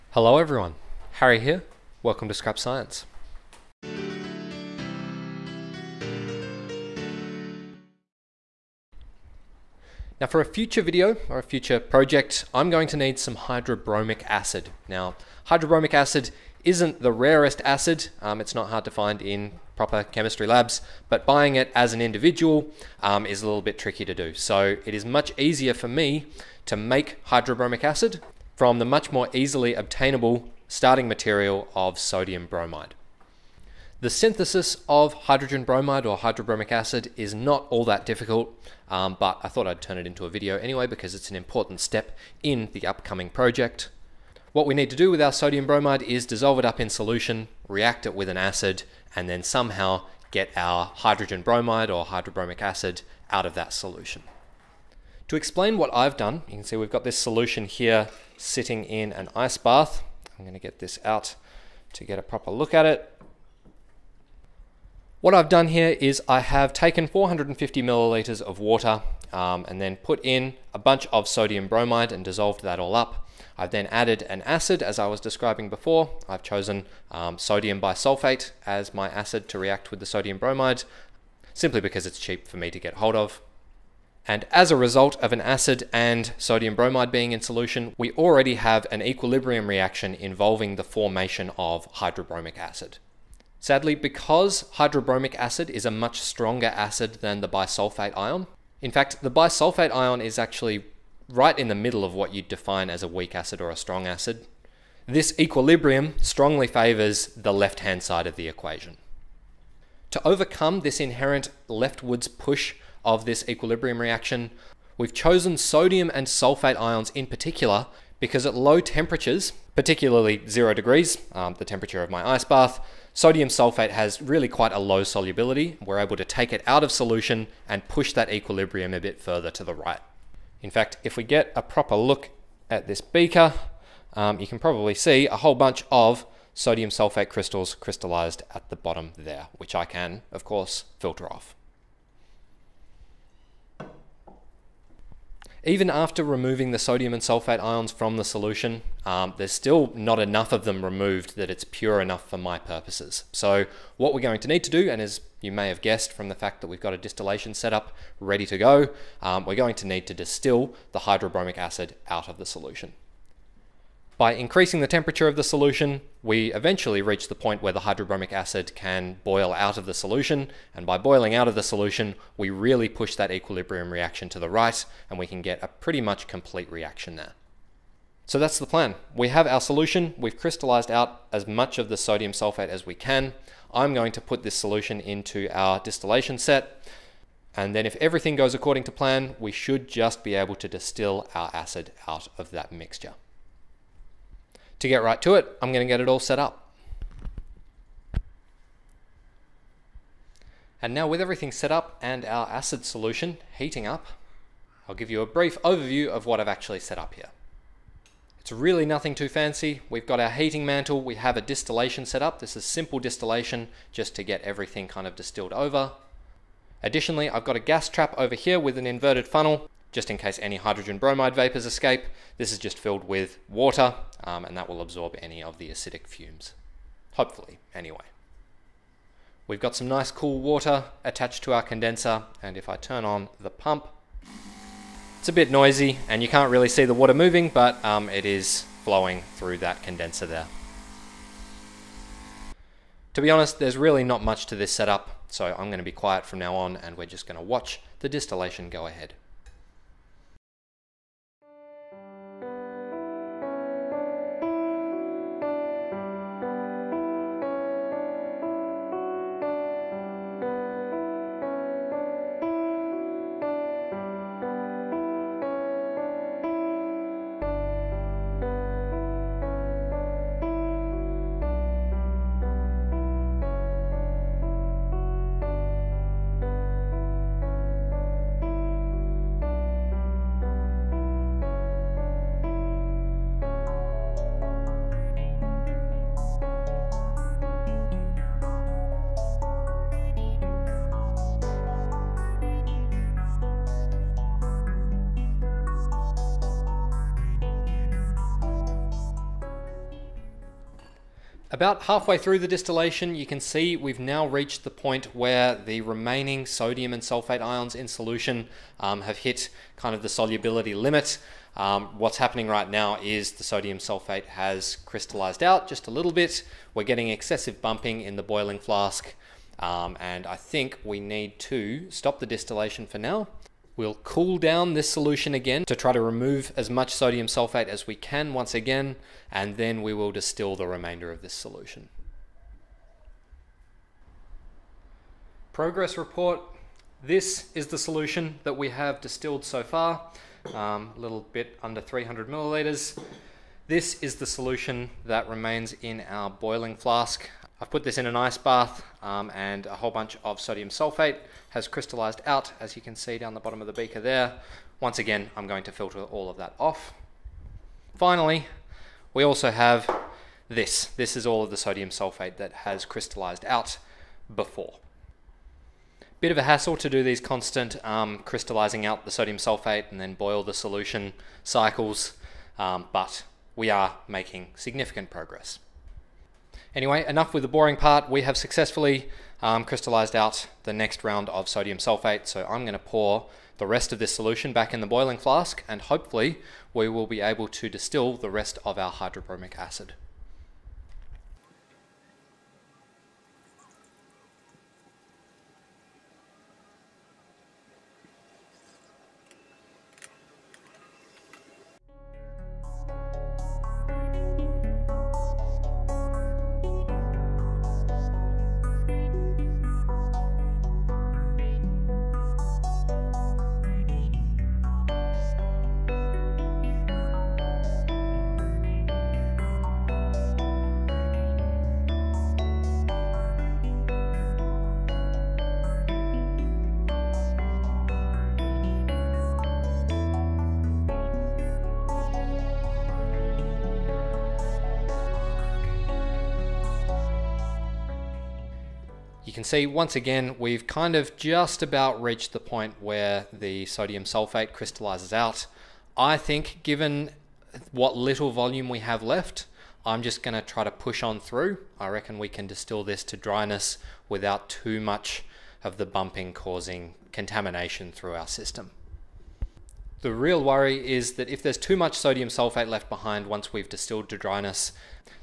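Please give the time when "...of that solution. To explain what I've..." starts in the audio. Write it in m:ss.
0:53.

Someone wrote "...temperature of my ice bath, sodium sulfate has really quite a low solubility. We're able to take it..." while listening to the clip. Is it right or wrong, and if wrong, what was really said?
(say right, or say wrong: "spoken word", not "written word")
right.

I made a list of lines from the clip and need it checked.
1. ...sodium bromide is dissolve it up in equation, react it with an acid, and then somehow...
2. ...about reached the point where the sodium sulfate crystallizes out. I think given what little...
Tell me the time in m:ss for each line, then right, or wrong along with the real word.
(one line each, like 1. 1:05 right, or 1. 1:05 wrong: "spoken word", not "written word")
1. 0:45 wrong: "solution", not "equation"
2. 7:21 right.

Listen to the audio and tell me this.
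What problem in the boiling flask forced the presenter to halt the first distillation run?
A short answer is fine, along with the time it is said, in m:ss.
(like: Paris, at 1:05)
Excessive bumping, at 5:17.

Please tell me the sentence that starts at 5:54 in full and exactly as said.
Once again, I'm going to filter all of that off.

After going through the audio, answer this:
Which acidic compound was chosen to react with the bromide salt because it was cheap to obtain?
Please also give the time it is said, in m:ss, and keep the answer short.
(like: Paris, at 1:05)
Sodium bisulfate, at 1:17.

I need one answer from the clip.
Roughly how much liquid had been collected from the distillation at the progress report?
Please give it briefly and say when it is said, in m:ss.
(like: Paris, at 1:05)
A little under 300 milliliters, at 5:40.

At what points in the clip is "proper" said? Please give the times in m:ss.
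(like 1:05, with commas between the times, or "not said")
0:19, 1:02, 2:11.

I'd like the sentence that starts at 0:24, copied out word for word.
So it is much easier for me to make hydrobromic acid from the much more easily obtainable starting material of sodium bromide.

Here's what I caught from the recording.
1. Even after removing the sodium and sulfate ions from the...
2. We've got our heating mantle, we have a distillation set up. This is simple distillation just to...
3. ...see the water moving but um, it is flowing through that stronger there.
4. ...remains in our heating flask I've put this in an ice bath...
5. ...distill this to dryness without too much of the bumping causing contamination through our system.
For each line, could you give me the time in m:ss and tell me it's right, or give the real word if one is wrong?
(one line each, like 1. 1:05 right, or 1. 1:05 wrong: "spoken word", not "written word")
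1. 2:25 right
2. 3:29 right
3. 3:56 wrong: "condenser", not "stronger"
4. 5:45 wrong: "boiling", not "heating"
5. 7:32 right.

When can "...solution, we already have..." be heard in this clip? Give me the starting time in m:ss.
1:27.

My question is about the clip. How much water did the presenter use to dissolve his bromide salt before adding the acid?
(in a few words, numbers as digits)
450 milliliters.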